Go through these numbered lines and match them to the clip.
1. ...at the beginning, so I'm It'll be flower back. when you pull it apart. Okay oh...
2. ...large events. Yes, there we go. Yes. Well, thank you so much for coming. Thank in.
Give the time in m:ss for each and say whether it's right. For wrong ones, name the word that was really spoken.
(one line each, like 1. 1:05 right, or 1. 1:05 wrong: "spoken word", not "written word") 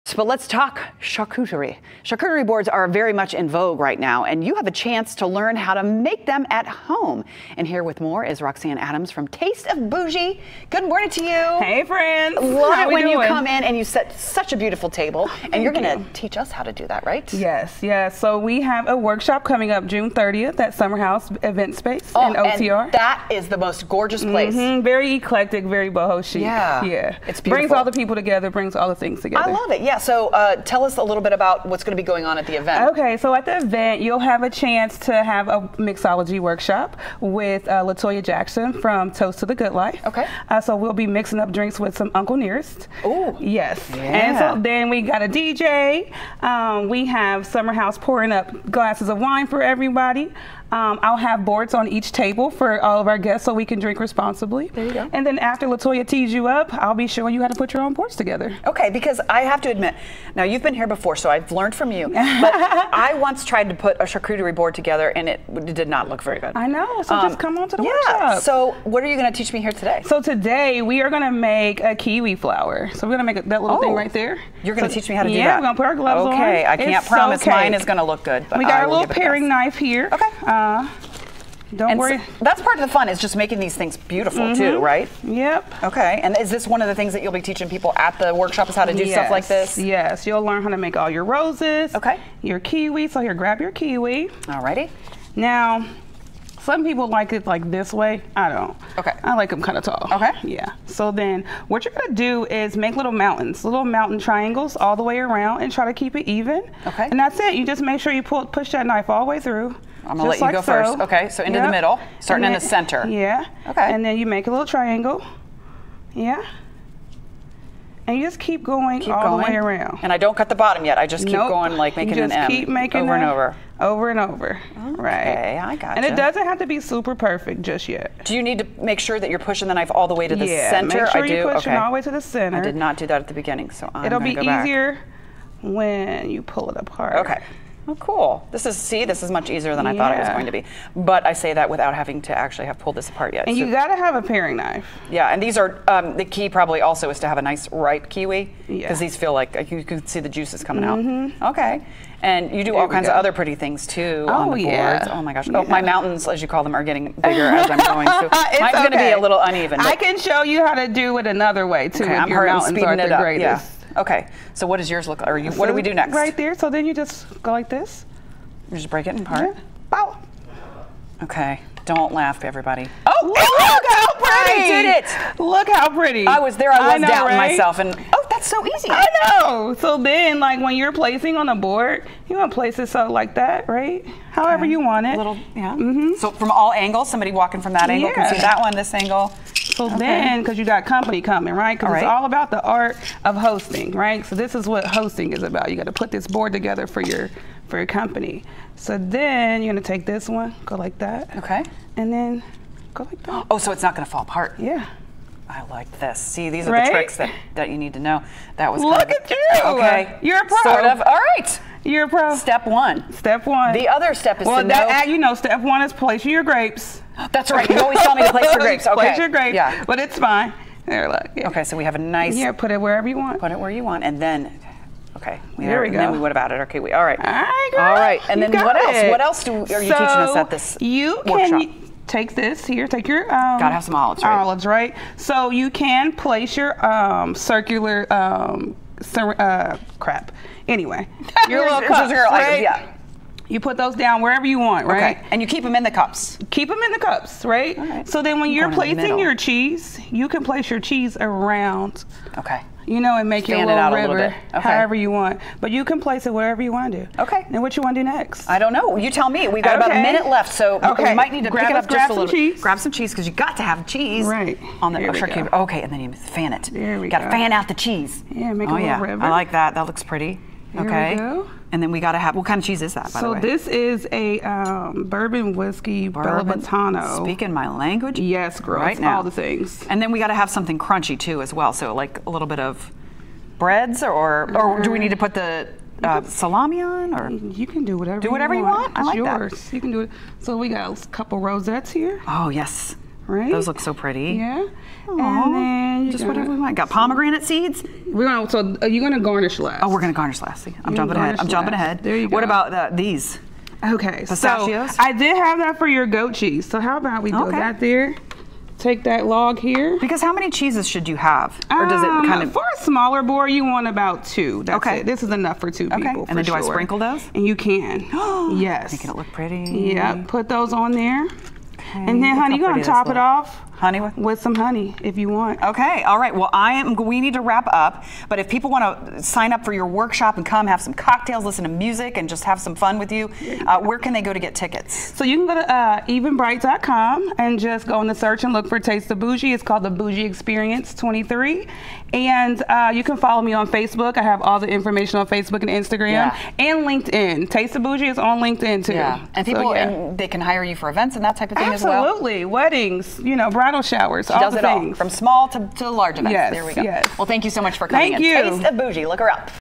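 1. 2:13 wrong: "easier", not "flower"
2. 5:55 right.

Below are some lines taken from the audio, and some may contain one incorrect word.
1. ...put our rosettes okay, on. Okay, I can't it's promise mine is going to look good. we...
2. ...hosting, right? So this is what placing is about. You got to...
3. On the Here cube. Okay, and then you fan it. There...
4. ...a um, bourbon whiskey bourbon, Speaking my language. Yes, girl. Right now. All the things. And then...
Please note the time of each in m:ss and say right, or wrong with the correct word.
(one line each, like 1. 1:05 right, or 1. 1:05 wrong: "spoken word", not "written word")
1. 1:15 wrong: "gloves", not "rosettes"
2. 3:13 wrong: "hosting", not "placing"
3. 4:24 right
4. 4:34 right.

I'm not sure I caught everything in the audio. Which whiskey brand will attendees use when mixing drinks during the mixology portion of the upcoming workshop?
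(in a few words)
Uncle Nearest.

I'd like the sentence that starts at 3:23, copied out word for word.
Oh, so it's not gonna fall apart.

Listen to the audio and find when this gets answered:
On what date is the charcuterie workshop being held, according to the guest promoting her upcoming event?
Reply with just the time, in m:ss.
0:19.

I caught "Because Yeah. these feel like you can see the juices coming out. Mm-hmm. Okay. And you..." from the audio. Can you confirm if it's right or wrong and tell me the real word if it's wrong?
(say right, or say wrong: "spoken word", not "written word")
right.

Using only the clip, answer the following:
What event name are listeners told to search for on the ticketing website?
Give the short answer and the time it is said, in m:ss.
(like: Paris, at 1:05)
The Bougie Experience 23, at 5:39.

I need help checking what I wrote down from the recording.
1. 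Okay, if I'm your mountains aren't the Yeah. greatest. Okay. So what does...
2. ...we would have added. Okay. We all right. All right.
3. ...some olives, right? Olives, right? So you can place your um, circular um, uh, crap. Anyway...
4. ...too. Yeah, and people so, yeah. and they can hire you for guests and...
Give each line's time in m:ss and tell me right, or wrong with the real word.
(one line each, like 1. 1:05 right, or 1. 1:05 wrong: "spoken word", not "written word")
1. 2:42 right
2. 3:46 right
3. 3:53 right
4. 5:48 wrong: "events", not "guests".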